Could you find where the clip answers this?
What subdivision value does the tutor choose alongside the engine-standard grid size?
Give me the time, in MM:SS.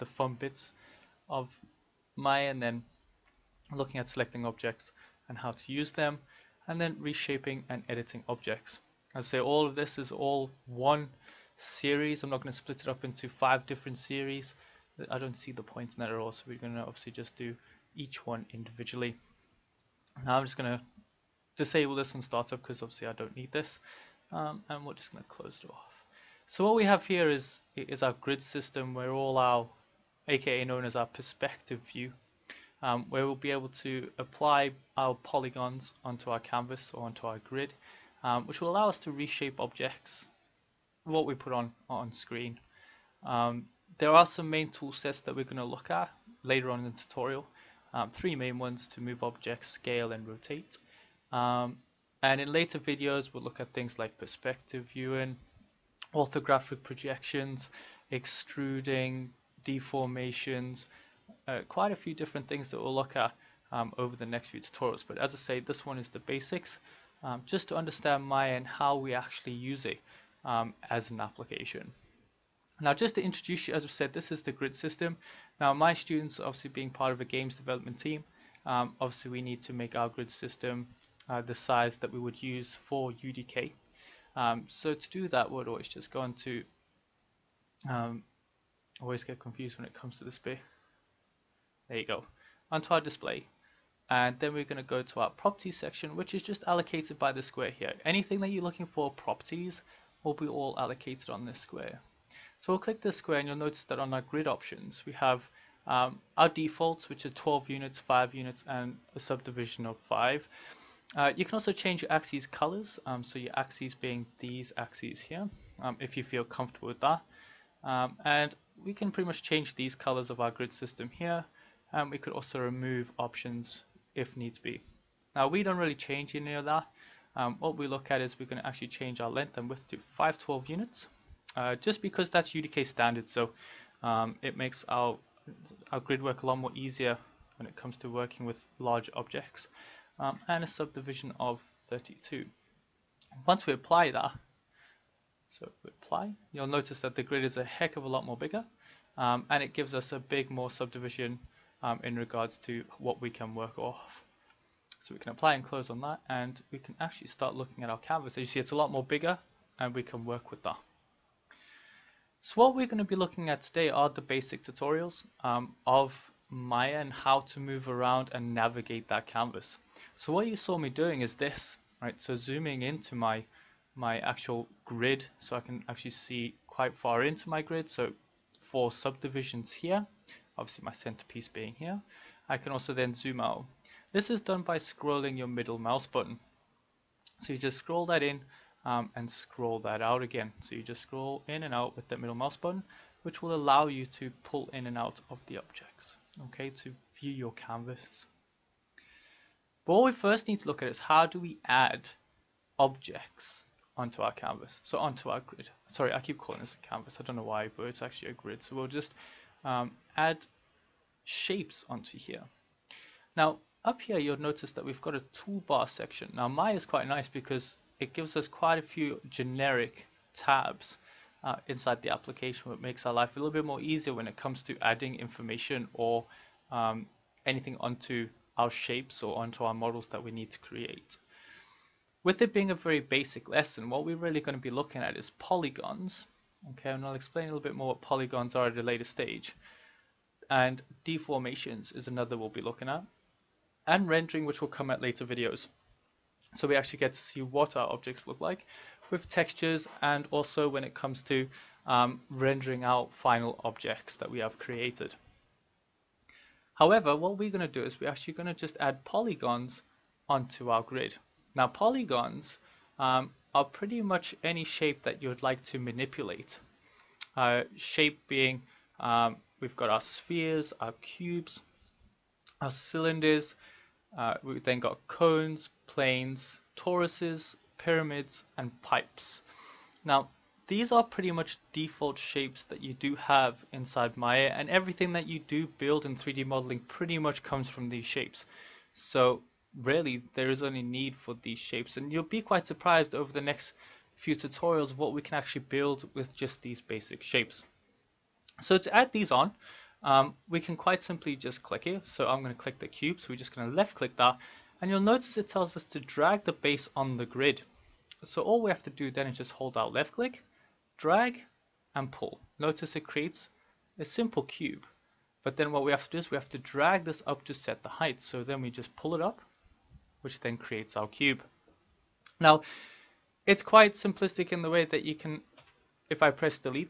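02:20.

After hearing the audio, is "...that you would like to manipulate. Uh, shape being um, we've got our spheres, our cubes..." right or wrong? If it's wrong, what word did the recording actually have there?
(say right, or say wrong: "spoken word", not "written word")
right.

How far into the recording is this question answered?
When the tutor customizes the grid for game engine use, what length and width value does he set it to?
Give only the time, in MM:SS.
02:10.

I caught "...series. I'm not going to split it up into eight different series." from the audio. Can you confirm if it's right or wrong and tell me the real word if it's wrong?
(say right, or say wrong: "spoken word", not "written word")
wrong: "five", not "eight".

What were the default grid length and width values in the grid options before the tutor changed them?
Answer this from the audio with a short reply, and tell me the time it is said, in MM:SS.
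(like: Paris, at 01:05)
12 units, at 01:47.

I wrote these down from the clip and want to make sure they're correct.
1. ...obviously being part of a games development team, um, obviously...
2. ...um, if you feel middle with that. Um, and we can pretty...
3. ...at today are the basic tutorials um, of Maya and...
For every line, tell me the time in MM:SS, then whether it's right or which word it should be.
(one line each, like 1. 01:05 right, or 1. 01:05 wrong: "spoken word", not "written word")
1. 01:16 right
2. 01:55 wrong: "comfortable", not "middle"
3. 02:43 right.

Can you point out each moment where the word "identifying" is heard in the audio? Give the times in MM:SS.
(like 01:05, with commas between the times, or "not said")
not said.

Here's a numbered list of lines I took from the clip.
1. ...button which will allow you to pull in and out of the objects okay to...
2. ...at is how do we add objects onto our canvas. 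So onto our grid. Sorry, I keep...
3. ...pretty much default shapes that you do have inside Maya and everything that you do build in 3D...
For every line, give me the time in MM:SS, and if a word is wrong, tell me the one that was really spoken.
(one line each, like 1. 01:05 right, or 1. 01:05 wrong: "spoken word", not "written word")
1. 03:12 right
2. 03:20 right
3. 04:41 right.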